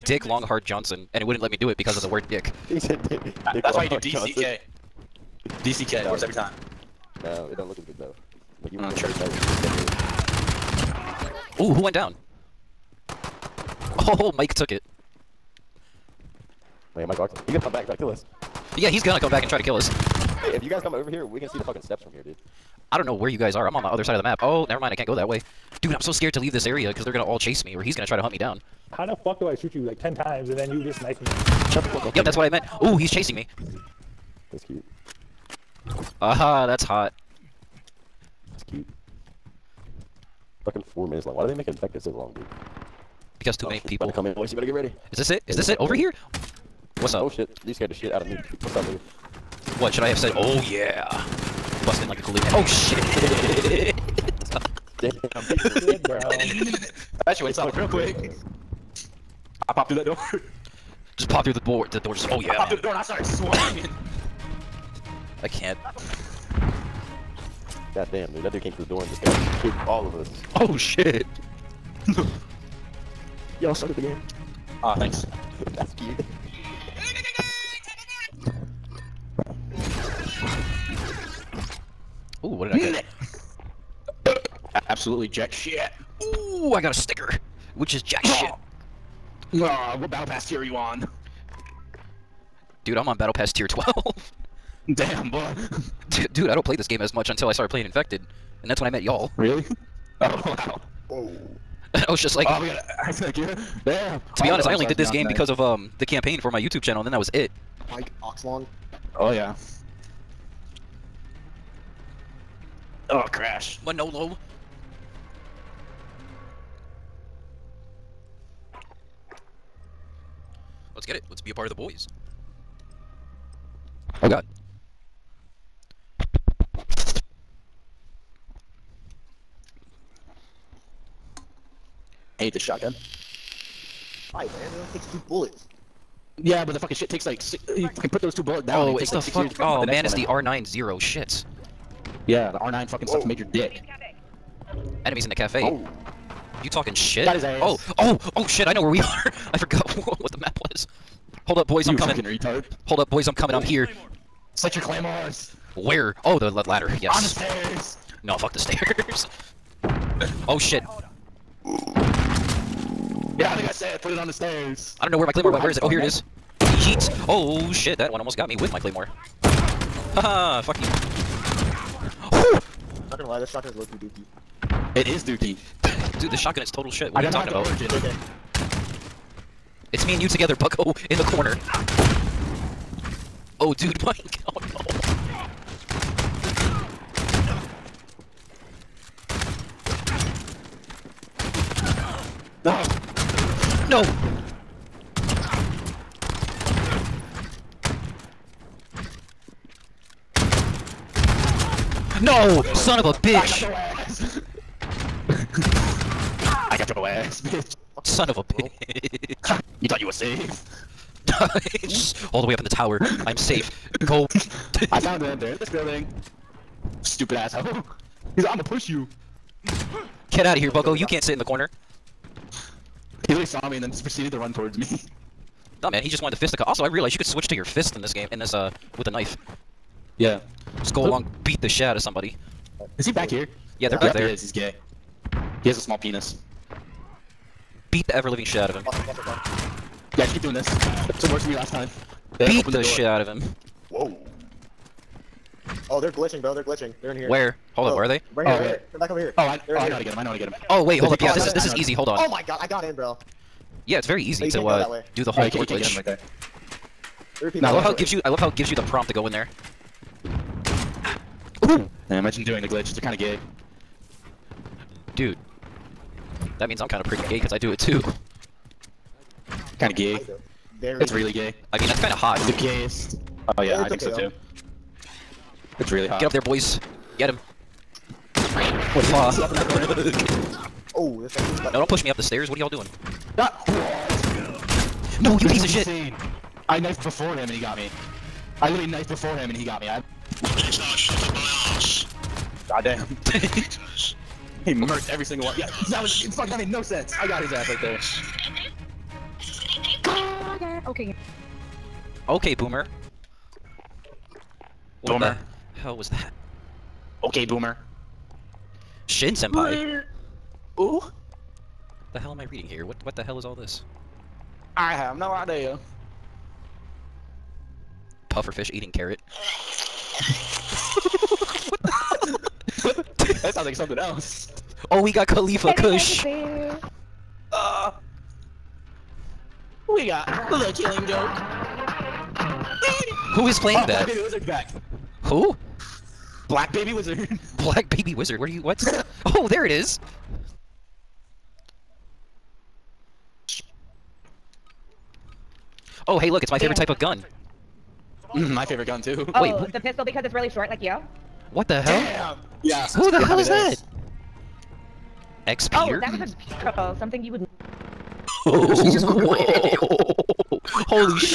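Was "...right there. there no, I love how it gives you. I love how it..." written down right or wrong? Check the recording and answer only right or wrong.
right.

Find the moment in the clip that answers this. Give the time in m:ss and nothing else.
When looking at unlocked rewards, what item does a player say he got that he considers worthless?
1:26.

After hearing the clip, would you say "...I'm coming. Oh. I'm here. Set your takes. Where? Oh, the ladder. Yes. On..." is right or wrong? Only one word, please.
wrong.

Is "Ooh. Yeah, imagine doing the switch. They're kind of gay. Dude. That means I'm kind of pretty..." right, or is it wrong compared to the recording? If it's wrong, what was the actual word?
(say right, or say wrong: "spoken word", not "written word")
wrong: "glitch", not "switch".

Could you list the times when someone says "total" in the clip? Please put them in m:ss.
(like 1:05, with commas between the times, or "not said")
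2:56.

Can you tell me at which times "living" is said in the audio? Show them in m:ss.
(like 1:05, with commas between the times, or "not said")
3:58.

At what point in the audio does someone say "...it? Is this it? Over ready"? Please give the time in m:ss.
0:45.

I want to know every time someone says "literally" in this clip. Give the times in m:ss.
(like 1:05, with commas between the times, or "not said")
3:43, 4:48.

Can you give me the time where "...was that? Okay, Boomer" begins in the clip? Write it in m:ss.
5:05.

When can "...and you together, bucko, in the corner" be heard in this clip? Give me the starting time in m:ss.
3:00.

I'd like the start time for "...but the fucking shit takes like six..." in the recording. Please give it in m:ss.
2:16.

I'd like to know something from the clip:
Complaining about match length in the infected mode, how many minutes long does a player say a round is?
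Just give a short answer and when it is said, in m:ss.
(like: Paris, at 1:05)
4 minutes, at 0:40.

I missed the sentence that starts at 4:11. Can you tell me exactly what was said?
Yeah, this is this is easy.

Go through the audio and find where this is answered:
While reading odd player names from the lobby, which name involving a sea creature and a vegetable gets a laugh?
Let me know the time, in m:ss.
5:18.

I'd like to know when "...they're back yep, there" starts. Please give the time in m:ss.
3:53.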